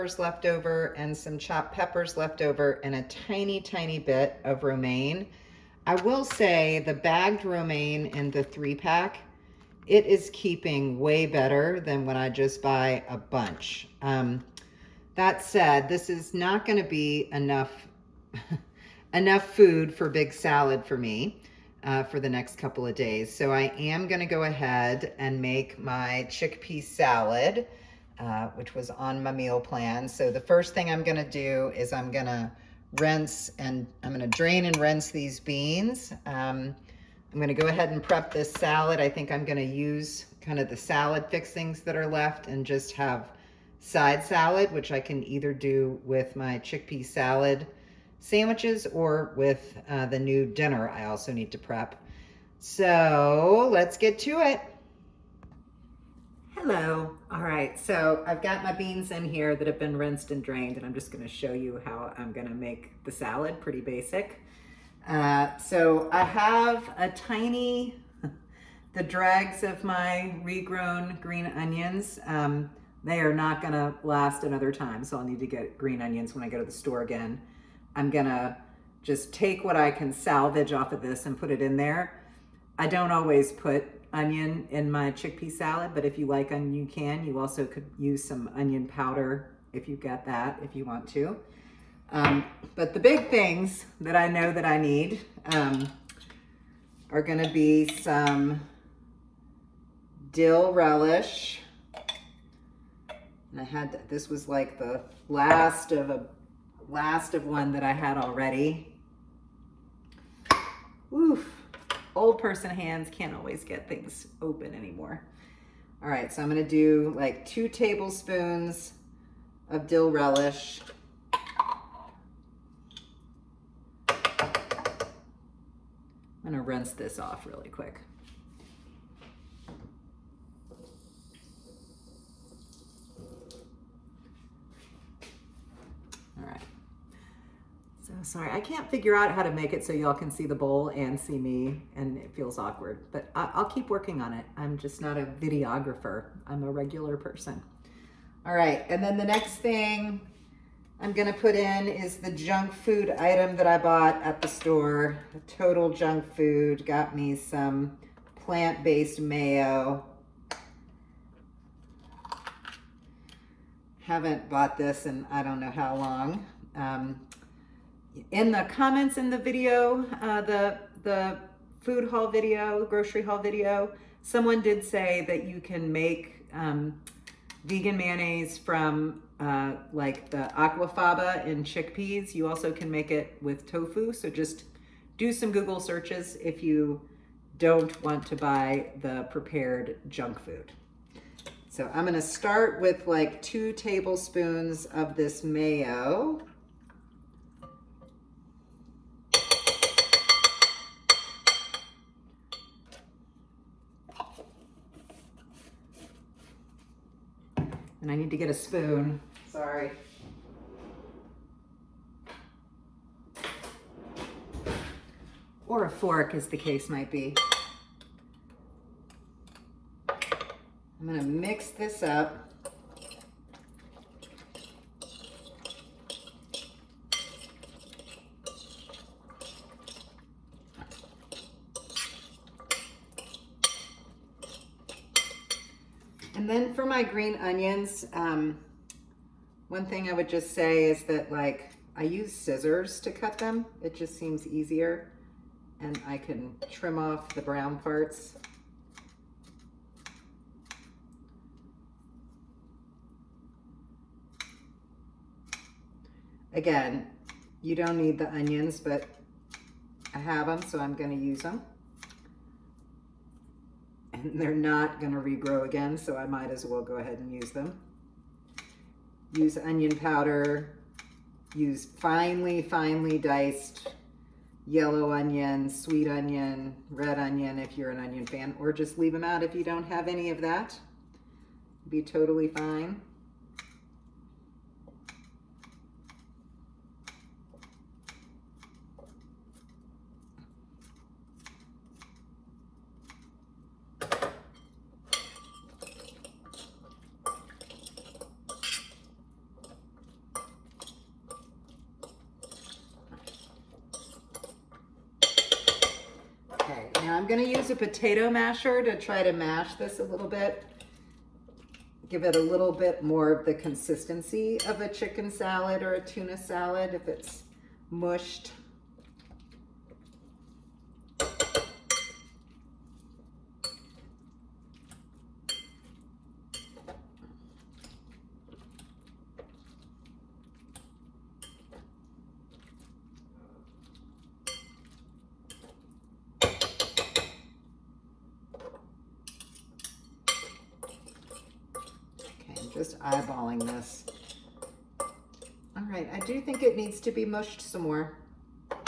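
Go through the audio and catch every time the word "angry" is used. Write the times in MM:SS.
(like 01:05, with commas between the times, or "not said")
not said.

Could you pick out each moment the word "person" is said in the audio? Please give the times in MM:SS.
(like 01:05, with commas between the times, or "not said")
01:52, 02:27.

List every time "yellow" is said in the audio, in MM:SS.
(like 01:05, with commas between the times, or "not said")
04:34.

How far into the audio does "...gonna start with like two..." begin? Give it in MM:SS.
03:12.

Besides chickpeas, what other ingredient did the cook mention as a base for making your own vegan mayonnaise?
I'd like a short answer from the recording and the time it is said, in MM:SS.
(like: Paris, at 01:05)
tofu, at 03:03.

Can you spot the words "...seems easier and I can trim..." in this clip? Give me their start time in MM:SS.
04:04.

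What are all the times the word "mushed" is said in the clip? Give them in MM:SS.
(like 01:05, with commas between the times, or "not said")
05:17, 05:47.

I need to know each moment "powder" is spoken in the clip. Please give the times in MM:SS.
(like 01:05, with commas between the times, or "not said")
01:28, 04:29.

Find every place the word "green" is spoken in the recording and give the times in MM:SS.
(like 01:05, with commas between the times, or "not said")
01:11, 01:15, 03:57.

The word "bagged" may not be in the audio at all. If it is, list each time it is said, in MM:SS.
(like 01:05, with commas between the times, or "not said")
00:06.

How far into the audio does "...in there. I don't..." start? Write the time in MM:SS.
01:21.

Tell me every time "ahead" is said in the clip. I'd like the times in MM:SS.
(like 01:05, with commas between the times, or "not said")
00:24, 00:37, 04:26.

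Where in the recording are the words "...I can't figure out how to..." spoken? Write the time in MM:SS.
02:18.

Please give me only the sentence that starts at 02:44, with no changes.
Haven't bought this in I don't know how long.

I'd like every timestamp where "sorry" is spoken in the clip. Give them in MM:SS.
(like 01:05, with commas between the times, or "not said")
02:18, 03:29.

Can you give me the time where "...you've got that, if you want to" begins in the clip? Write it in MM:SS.
01:29.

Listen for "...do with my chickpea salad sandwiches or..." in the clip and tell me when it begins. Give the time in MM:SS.
00:45.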